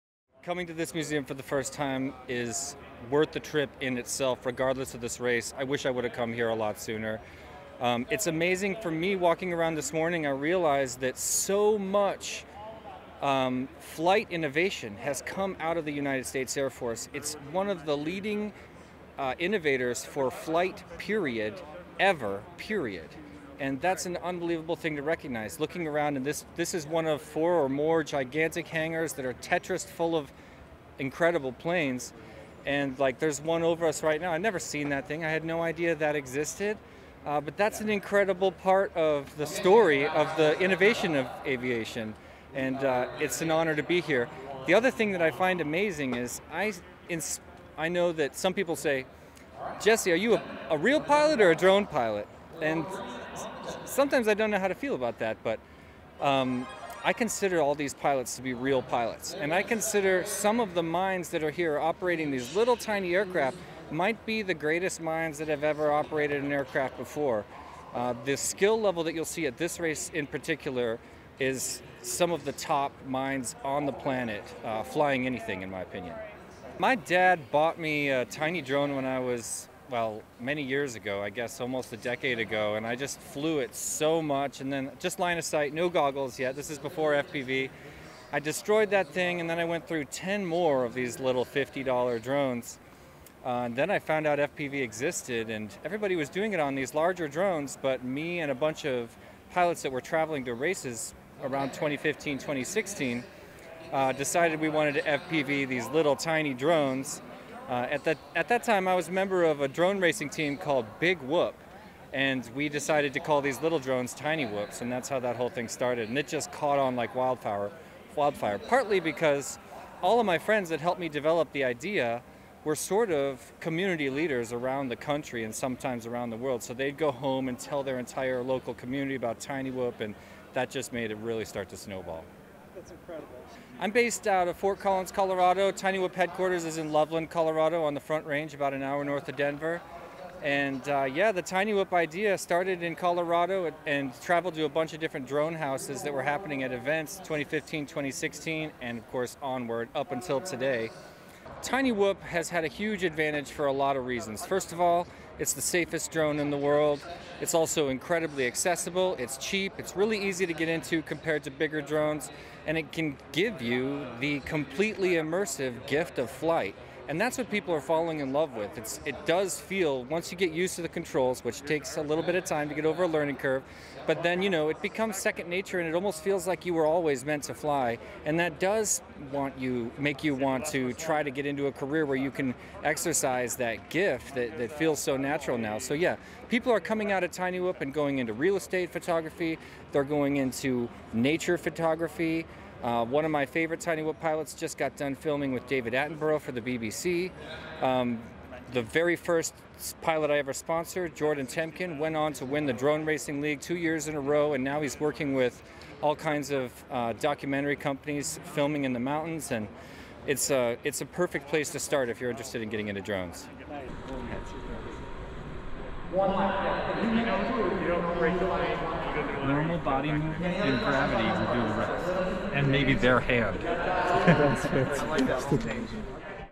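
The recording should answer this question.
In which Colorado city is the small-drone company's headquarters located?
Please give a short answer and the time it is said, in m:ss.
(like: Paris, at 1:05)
Loveland, at 2:16.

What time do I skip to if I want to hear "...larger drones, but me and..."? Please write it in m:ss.
1:36.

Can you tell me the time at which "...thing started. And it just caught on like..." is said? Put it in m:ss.
1:55.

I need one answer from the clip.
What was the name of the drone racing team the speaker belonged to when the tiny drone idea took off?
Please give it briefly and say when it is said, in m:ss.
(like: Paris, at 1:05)
Big Whoop, at 1:50.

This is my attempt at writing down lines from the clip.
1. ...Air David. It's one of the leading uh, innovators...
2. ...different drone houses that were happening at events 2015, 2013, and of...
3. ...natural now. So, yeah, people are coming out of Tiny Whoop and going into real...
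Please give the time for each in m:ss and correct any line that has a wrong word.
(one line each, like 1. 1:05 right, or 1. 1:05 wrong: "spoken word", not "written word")
1. 0:16 wrong: "Force", not "David"
2. 2:24 wrong: "2016", not "2013"
3. 3:05 right.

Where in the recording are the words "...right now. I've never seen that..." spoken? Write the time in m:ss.
0:34.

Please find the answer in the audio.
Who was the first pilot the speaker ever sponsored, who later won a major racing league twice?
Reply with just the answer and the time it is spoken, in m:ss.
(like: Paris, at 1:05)
Jordan Temkin, at 3:21.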